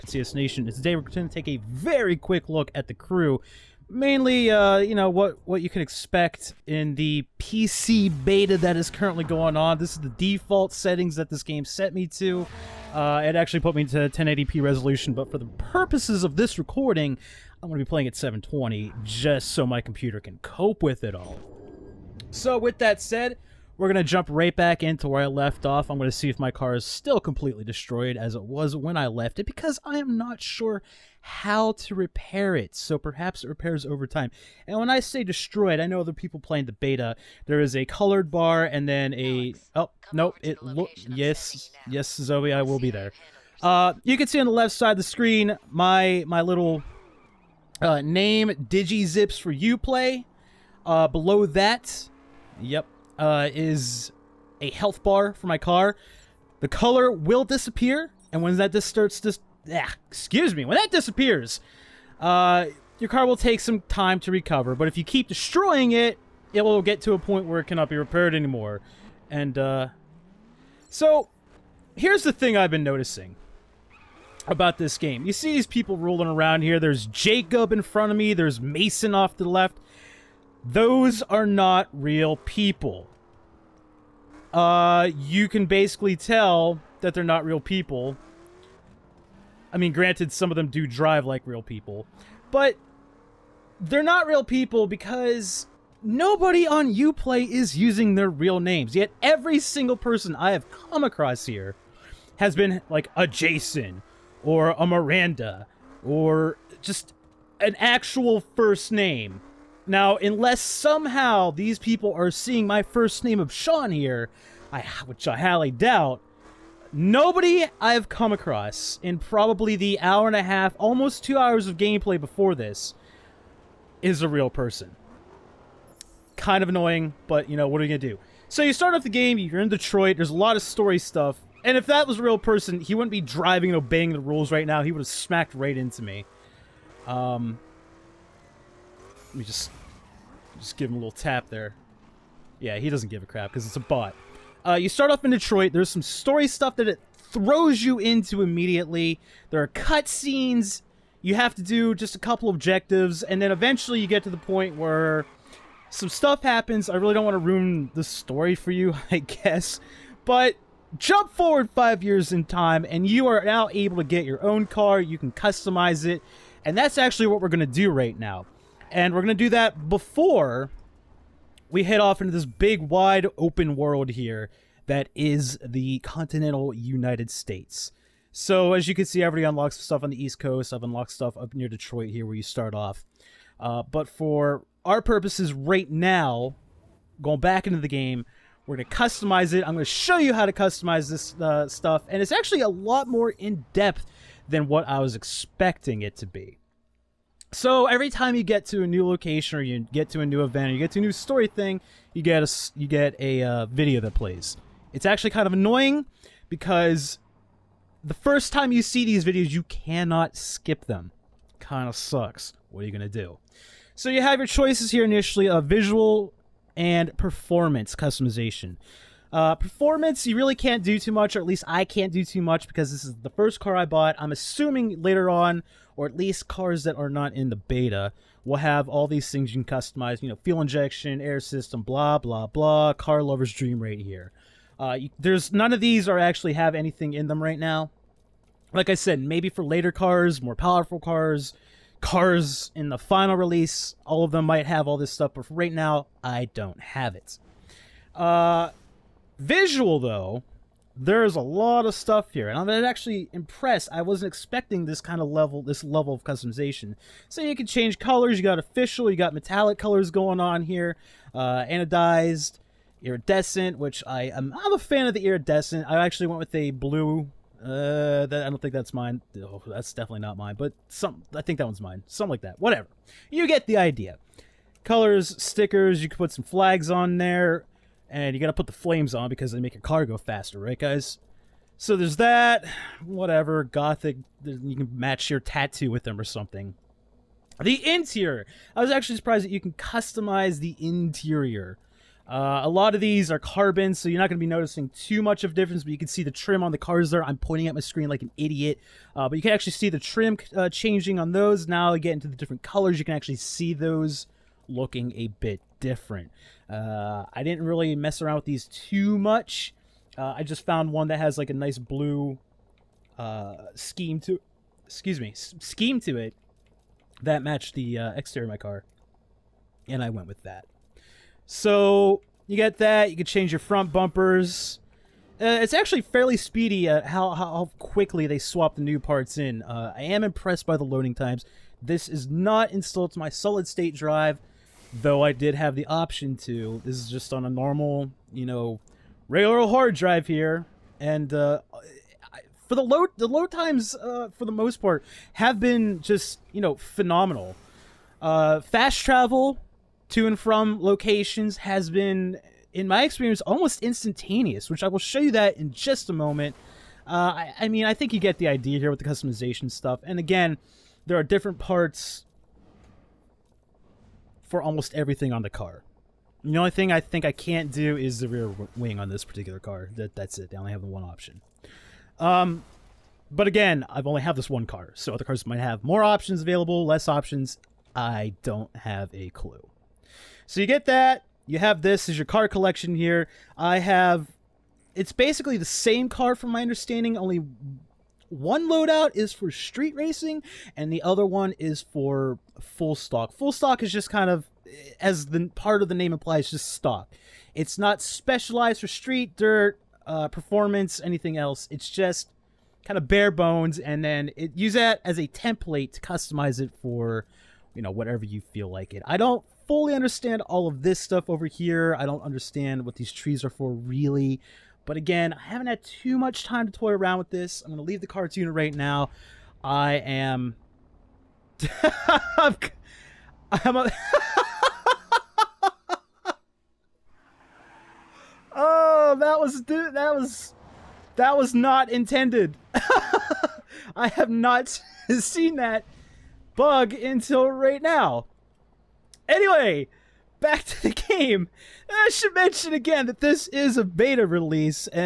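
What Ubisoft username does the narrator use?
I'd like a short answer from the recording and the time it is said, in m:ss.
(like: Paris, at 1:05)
DigiZips, at 0:48.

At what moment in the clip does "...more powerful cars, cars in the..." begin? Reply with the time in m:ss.
4:00.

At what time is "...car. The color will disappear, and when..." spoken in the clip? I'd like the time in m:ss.
0:55.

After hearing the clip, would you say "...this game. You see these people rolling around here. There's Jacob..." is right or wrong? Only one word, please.
right.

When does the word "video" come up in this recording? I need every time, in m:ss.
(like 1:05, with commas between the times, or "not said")
3:23, 3:29.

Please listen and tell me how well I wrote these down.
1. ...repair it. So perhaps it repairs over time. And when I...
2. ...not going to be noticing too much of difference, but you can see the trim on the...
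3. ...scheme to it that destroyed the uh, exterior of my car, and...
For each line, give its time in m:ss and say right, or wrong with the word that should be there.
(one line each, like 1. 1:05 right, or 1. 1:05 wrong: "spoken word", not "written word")
1. 0:31 right
2. 4:54 right
3. 5:15 wrong: "matched", not "destroyed".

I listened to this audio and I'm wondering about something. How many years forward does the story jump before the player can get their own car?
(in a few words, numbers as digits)
5.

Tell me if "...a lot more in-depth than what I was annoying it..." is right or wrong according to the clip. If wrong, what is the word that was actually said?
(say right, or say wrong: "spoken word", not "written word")
wrong: "expecting", not "annoying".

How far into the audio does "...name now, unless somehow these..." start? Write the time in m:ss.
1:48.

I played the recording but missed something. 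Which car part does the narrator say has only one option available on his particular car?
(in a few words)
rear wing.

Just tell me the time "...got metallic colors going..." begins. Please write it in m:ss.
4:19.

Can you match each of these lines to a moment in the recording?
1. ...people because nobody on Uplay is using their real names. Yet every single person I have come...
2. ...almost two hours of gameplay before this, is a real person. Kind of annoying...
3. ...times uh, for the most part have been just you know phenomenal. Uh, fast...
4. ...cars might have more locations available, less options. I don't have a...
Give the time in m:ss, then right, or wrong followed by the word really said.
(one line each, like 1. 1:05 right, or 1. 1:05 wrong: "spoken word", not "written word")
1. 1:34 right
2. 2:00 right
3. 5:43 right
4. 6:15 wrong: "options", not "locations".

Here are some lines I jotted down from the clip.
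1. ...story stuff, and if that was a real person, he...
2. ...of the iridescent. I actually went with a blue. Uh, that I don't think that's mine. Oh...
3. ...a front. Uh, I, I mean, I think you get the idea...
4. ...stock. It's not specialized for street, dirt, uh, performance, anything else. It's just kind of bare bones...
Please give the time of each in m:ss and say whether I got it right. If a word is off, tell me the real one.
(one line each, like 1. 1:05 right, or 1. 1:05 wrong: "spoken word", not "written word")
1. 2:10 right
2. 4:25 right
3. 5:56 wrong: "moment", not "front"
4. 6:36 right.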